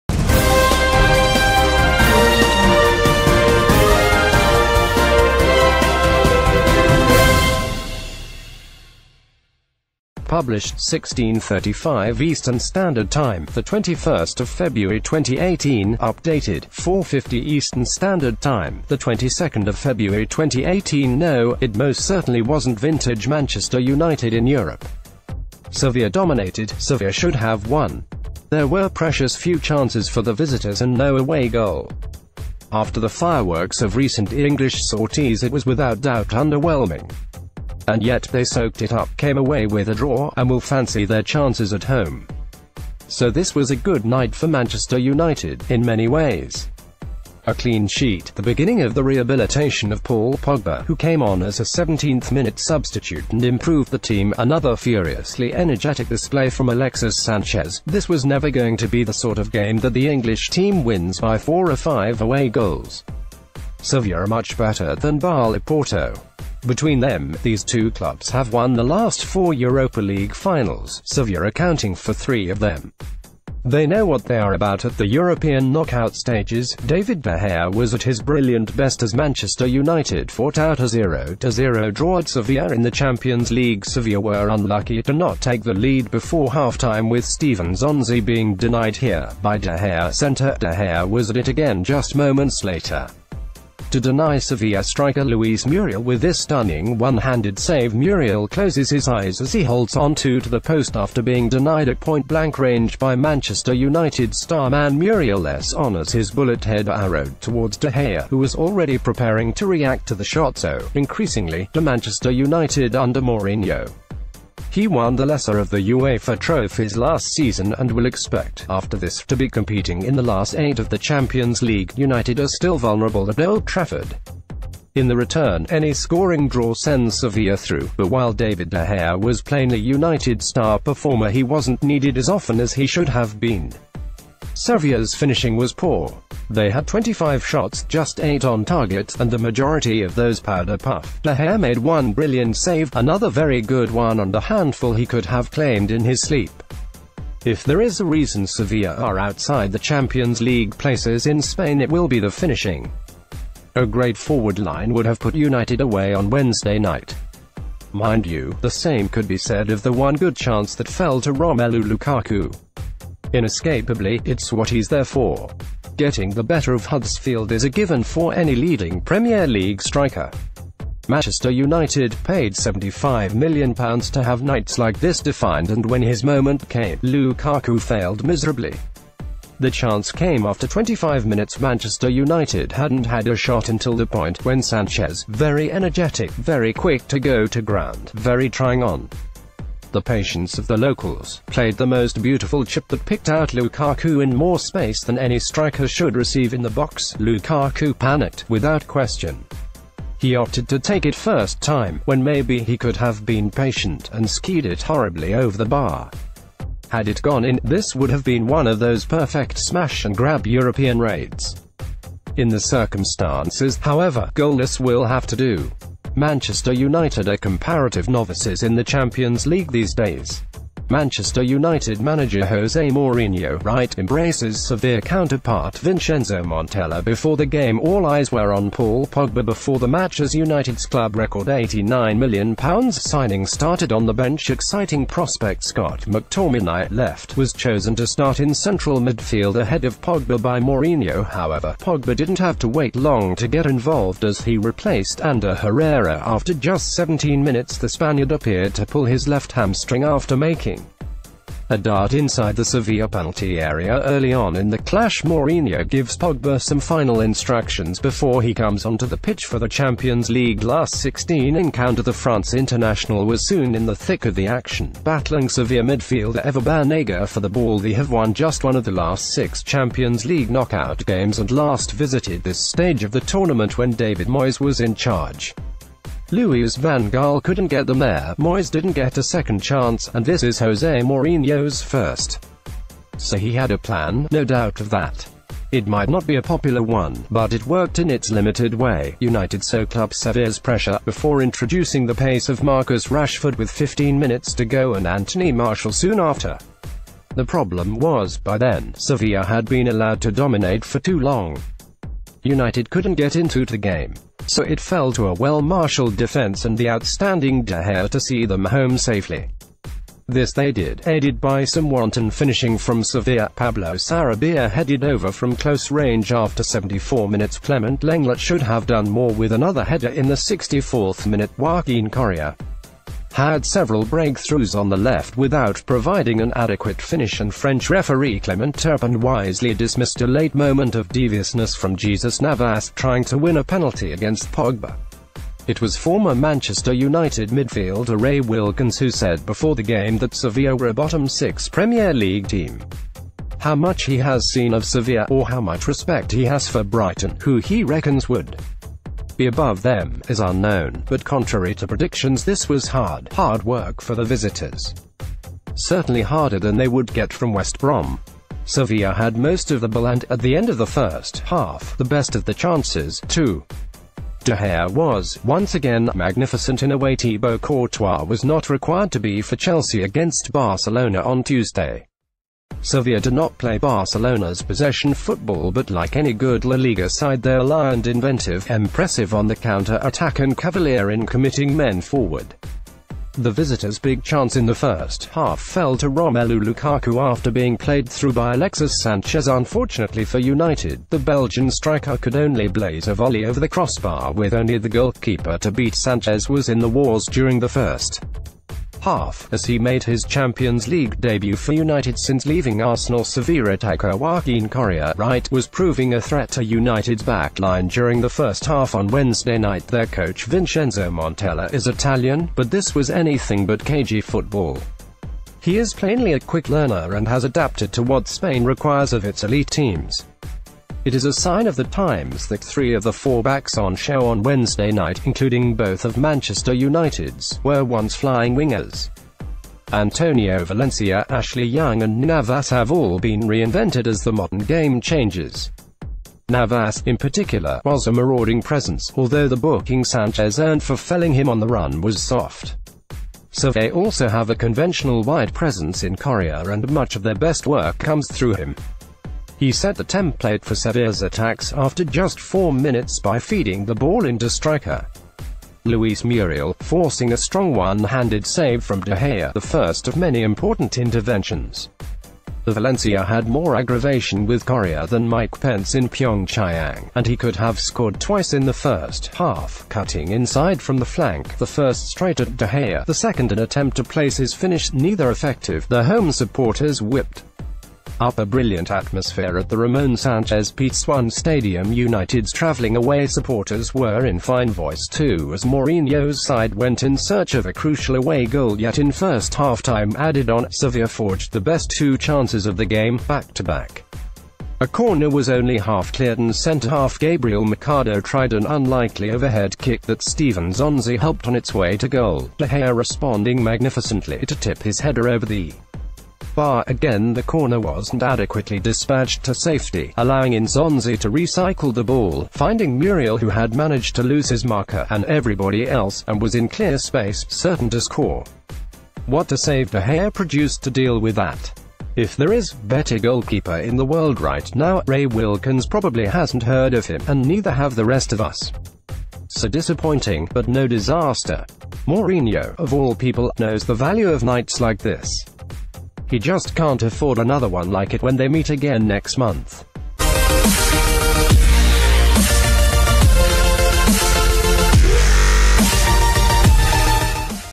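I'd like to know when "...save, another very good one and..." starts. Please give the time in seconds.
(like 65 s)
142 s.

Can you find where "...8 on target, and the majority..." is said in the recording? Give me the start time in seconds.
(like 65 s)
138 s.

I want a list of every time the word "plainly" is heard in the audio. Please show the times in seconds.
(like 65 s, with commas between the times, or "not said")
129 s, 415 s.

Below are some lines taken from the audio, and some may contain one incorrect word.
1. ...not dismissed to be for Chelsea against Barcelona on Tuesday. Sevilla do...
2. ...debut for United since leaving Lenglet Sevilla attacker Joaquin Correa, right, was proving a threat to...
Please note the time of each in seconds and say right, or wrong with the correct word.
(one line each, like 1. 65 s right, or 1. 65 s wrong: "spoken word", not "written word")
1. 368 s wrong: "required", not "dismissed"
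2. 401 s wrong: "Arsenal", not "Lenglet".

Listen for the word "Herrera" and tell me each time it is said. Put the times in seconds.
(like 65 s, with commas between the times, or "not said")
245 s.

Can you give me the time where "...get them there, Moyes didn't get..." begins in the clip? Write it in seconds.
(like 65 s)
277 s.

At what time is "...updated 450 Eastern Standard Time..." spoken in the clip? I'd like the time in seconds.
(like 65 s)
15 s.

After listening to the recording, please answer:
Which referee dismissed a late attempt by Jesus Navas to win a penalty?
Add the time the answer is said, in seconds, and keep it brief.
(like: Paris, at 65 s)
Clement Turpin, at 328 s.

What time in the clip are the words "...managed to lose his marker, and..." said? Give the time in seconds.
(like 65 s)
513 s.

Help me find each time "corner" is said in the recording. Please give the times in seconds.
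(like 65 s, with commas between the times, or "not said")
494 s, 507 s.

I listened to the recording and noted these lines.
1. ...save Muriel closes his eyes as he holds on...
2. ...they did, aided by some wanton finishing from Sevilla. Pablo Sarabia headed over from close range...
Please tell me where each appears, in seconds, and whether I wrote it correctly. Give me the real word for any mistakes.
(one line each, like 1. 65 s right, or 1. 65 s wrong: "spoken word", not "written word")
1. 97 s right
2. 310 s right.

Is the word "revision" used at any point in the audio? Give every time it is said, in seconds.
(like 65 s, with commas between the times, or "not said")
not said.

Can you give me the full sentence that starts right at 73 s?
They know what they are about at the European knockout stages.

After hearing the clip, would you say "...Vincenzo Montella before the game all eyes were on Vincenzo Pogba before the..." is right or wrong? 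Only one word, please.
wrong.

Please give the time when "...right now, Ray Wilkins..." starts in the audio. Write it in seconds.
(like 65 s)
524 s.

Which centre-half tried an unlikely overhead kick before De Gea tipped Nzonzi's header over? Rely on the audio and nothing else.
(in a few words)
Gabriel Mercado.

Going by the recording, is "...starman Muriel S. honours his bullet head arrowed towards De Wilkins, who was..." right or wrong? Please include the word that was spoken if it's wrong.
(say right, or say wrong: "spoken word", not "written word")
wrong: "Gea", not "Wilkins".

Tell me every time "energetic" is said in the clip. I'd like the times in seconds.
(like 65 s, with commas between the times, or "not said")
55 s, 185 s.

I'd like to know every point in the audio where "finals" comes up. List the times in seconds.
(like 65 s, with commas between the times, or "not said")
70 s, 256 s.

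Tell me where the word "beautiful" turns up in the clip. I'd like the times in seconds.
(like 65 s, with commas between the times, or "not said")
192 s.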